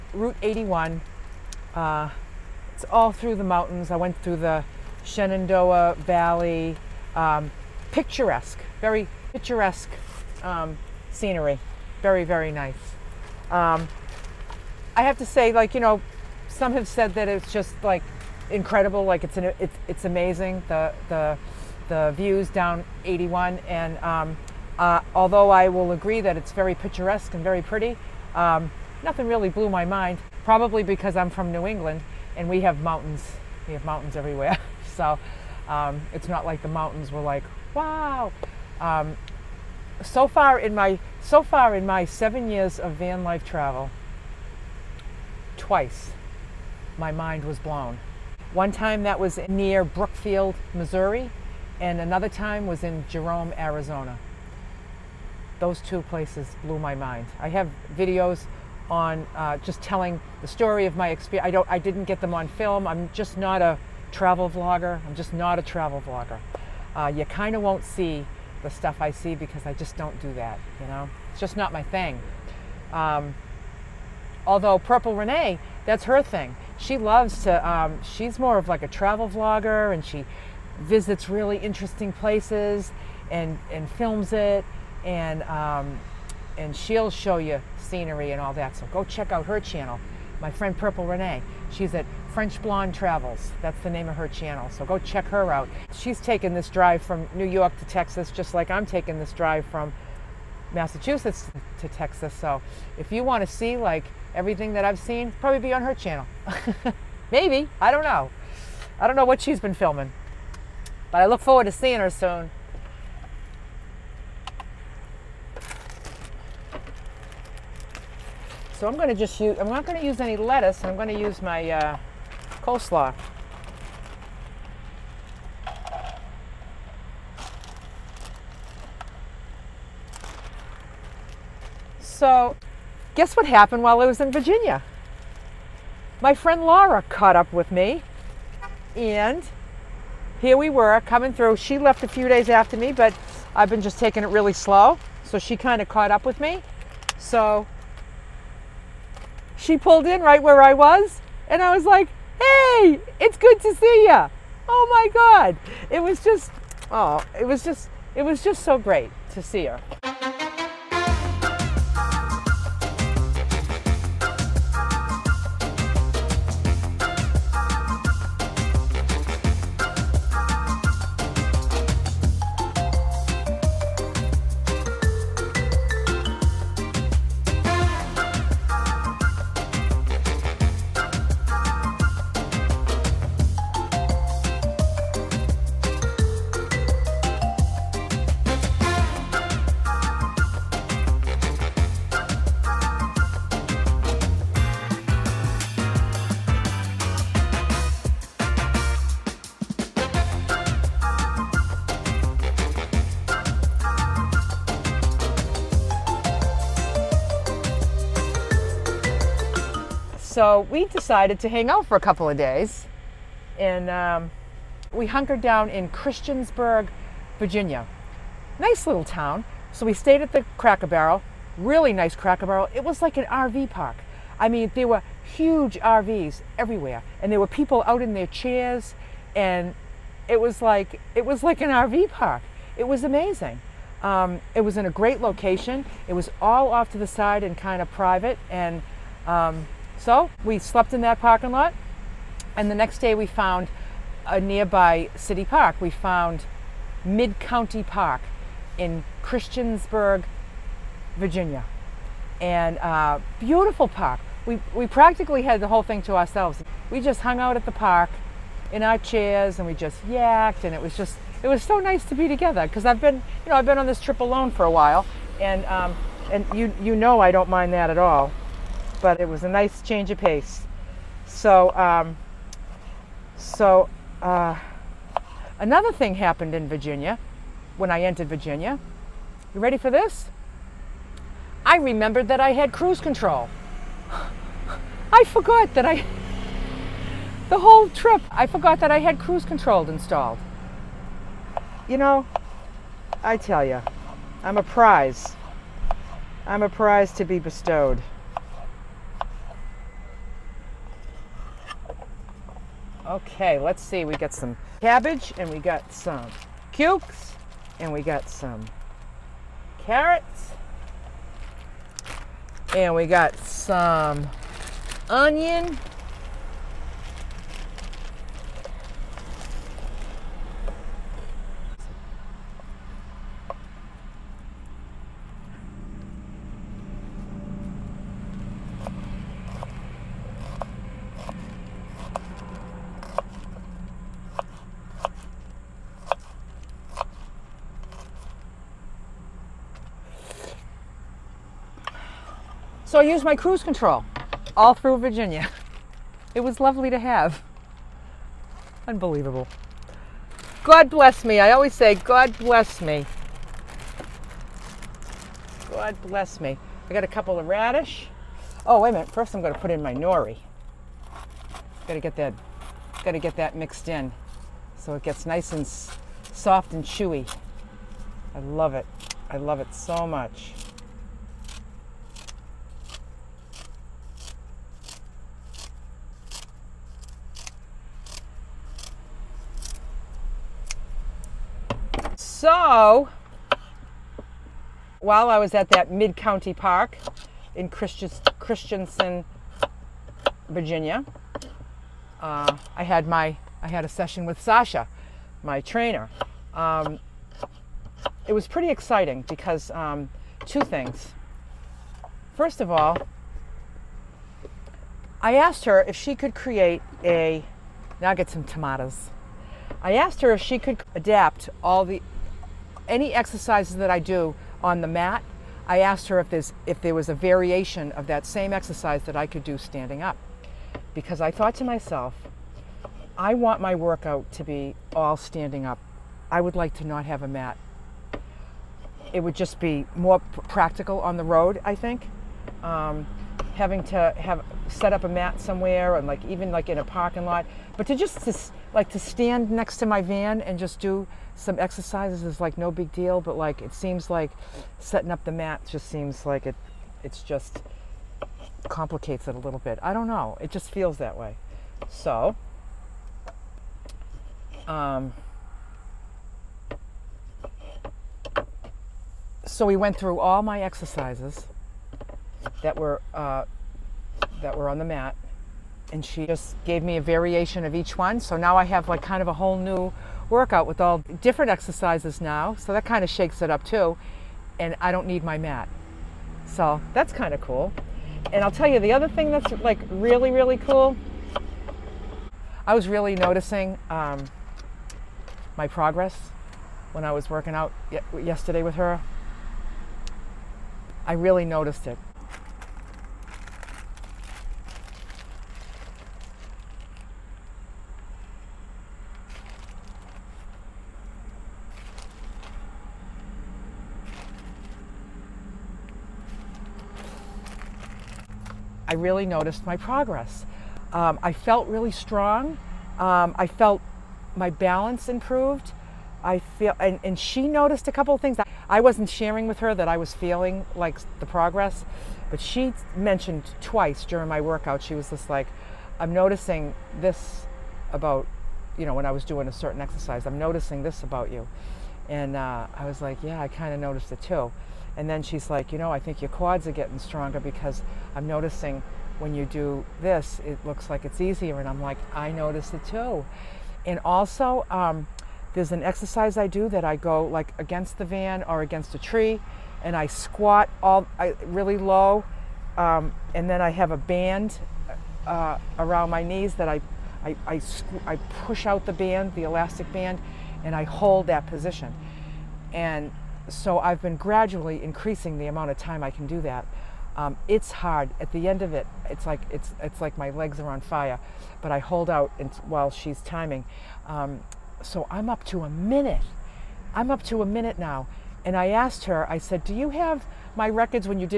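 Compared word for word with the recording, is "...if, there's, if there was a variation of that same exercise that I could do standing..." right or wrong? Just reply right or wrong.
right.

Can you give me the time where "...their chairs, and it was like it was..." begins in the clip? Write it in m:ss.
3:48.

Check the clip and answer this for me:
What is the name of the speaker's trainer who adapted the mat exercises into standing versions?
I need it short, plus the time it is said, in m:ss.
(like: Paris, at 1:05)
Sasha, at 6:34.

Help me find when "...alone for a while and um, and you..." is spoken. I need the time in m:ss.
4:24.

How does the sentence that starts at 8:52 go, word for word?
And uh, I was like, yeah, I kind of noticed it too.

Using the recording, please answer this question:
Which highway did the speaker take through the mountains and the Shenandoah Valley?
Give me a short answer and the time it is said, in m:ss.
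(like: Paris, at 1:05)
Route 81, at 0:00.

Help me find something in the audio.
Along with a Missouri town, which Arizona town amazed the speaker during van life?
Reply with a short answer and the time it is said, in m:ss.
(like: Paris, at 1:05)
Jerome, at 0:53.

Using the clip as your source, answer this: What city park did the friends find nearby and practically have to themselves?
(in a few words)
Mid County Park.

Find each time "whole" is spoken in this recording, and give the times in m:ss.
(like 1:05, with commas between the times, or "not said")
4:15, 4:47, 7:49.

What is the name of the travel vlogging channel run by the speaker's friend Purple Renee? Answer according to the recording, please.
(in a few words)
French Blonde Travels.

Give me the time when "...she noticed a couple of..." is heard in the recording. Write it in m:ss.
8:37.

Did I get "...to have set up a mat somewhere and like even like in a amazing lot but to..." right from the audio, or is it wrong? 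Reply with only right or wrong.
wrong.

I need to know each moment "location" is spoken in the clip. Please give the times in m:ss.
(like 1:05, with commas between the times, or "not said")
3:55.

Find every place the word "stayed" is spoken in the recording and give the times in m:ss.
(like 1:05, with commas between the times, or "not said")
3:39.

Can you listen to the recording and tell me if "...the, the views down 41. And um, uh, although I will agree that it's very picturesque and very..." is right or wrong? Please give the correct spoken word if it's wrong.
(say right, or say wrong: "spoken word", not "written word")
wrong: "81", not "41".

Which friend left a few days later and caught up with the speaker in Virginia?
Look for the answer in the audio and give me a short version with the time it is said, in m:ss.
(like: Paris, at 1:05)
Laura, at 2:16.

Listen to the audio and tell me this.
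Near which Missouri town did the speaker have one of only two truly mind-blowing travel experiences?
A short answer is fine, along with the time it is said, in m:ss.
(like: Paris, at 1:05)
Brookfield, at 0:49.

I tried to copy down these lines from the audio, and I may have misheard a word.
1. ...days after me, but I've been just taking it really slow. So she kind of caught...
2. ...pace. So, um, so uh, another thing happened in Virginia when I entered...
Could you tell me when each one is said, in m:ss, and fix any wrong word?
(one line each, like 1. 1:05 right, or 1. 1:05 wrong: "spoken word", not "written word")
1. 2:22 right
2. 4:30 right.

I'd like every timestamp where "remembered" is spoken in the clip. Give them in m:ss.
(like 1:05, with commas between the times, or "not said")
4:41.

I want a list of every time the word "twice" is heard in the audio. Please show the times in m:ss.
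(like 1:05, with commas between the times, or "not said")
0:45, 8:43.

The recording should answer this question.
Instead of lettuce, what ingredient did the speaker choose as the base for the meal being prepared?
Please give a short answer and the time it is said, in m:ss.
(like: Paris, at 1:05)
coleslaw, at 2:02.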